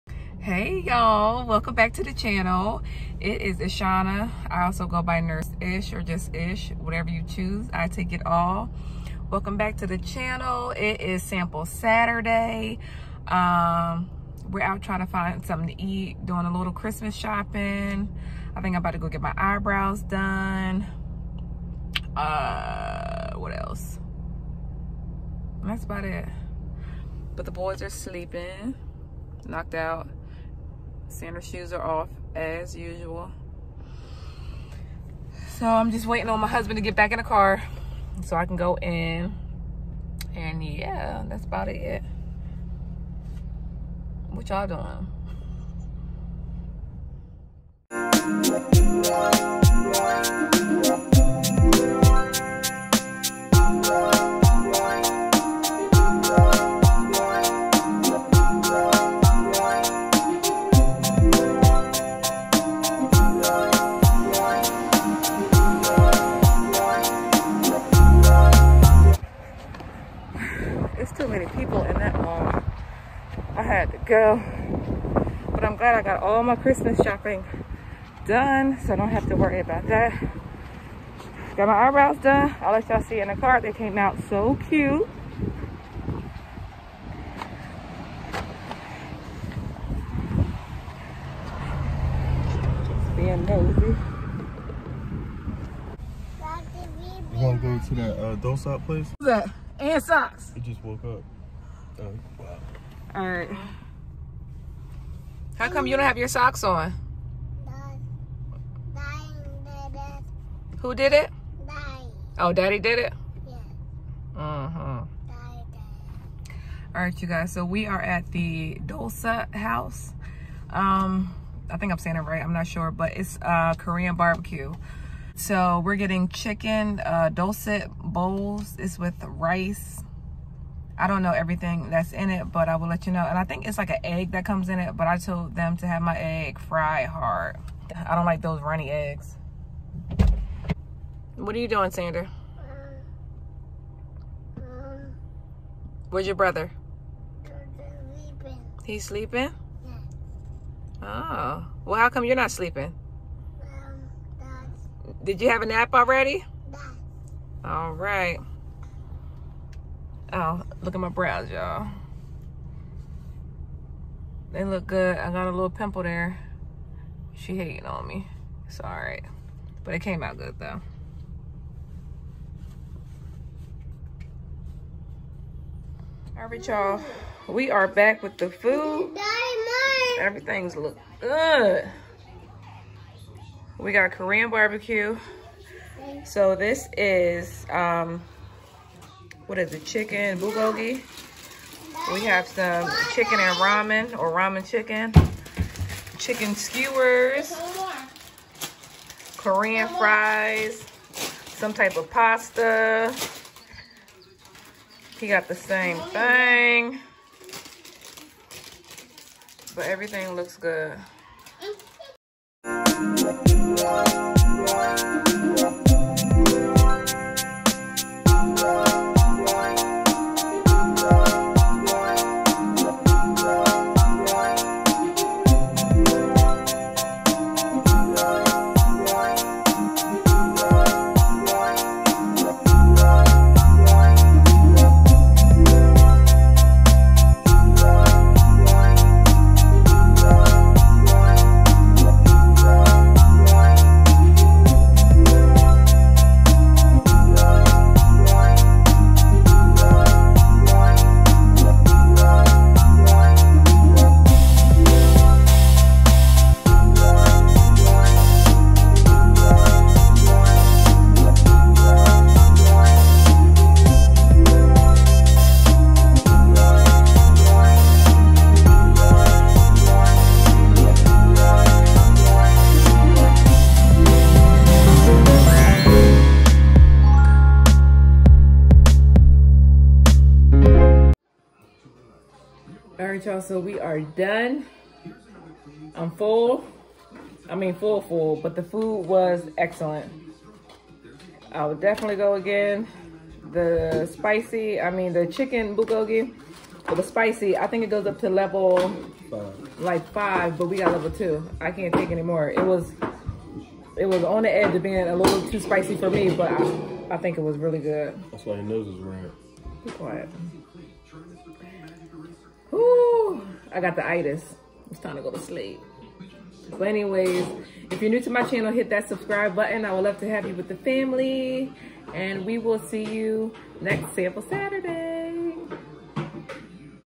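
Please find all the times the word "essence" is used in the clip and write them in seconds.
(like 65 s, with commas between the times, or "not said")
not said.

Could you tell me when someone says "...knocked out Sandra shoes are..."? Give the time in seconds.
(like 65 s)
29 s.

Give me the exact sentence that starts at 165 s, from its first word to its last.
I got a little pimple there.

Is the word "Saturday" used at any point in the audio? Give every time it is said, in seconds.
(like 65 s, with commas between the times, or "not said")
11 s, 324 s.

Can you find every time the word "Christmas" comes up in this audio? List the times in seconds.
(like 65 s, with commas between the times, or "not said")
16 s, 76 s.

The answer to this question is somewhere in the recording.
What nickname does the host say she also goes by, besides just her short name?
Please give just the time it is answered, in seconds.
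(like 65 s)
5 s.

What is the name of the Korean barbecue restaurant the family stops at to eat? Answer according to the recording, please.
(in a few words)
Dolsot House.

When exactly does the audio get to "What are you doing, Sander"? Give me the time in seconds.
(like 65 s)
141 s.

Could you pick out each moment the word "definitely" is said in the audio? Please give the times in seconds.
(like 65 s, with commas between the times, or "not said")
291 s.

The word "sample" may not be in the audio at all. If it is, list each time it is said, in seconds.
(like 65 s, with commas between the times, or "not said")
11 s, 324 s.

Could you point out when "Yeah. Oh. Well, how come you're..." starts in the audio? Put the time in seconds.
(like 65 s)
151 s.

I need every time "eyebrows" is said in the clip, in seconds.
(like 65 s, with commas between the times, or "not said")
19 s, 81 s.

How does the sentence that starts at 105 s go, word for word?
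How come you don't have your socks on?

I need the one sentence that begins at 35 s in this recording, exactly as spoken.
So I'm just waiting on my husband to get back in the car so I can go in.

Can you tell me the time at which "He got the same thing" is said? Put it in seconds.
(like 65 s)
205 s.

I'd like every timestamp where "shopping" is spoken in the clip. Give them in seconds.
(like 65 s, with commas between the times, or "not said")
17 s, 76 s.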